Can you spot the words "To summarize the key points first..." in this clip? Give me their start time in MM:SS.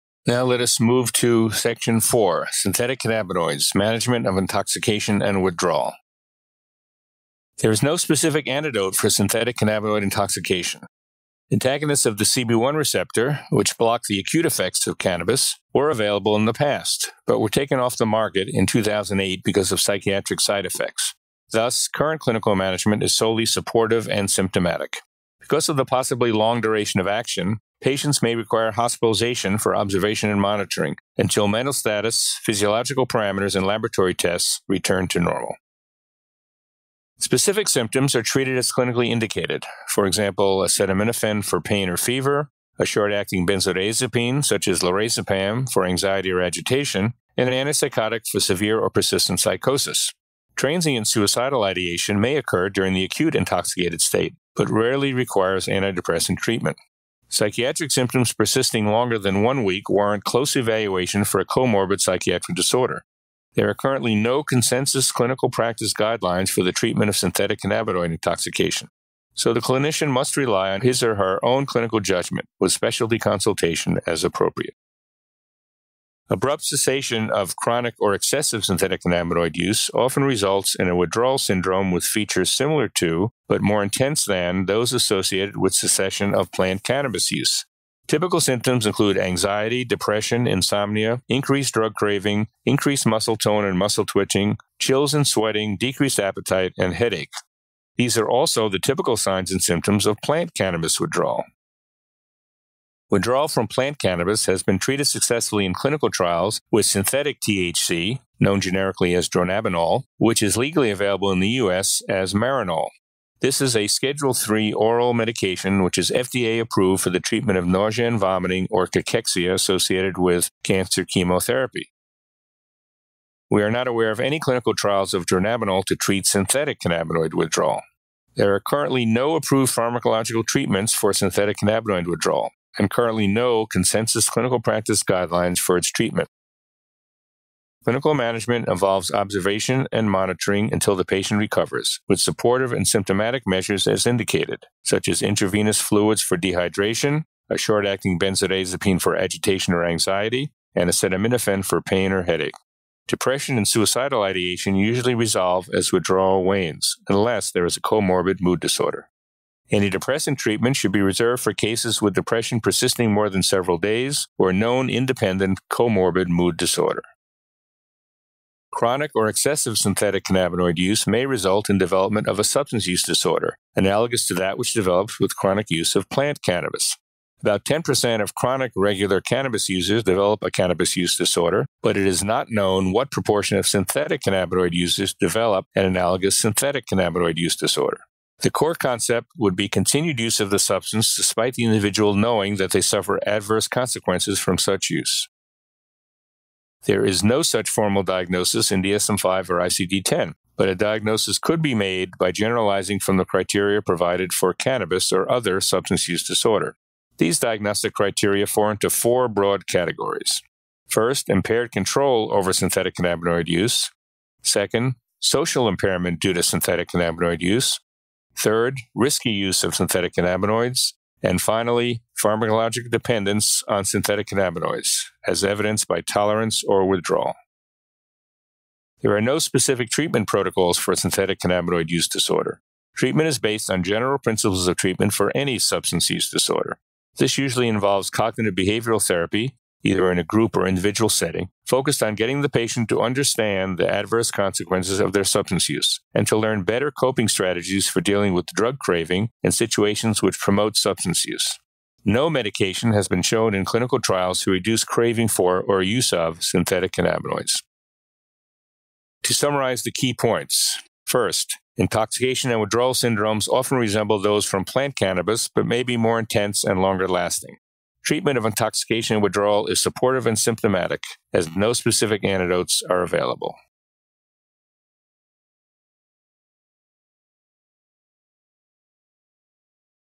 04:19.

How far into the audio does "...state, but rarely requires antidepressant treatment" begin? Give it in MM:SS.
00:54.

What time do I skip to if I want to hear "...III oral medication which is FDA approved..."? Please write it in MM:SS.
01:54.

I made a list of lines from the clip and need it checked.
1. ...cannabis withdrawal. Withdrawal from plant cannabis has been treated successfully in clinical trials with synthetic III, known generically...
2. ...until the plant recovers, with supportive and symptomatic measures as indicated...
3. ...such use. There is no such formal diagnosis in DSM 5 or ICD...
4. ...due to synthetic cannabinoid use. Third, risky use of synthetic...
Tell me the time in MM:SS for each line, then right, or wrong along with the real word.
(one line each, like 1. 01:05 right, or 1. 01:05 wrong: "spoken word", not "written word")
1. 01:40 wrong: "THC", not "III"
2. 02:20 wrong: "patient", not "plant"
3. 03:14 right
4. 03:36 right.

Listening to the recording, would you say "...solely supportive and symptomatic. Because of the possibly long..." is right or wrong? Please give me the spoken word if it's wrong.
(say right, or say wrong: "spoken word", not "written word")
right.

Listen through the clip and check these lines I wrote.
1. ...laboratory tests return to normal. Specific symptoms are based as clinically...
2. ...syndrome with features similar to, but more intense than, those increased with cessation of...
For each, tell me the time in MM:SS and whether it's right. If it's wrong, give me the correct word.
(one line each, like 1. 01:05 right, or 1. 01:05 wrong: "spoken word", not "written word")
1. 00:33 wrong: "treated", not "based"
2. 01:21 wrong: "associated", not "increased".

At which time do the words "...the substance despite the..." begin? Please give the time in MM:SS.
03:10.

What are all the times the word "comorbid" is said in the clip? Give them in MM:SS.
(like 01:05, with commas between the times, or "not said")
01:01, 02:37, 02:45.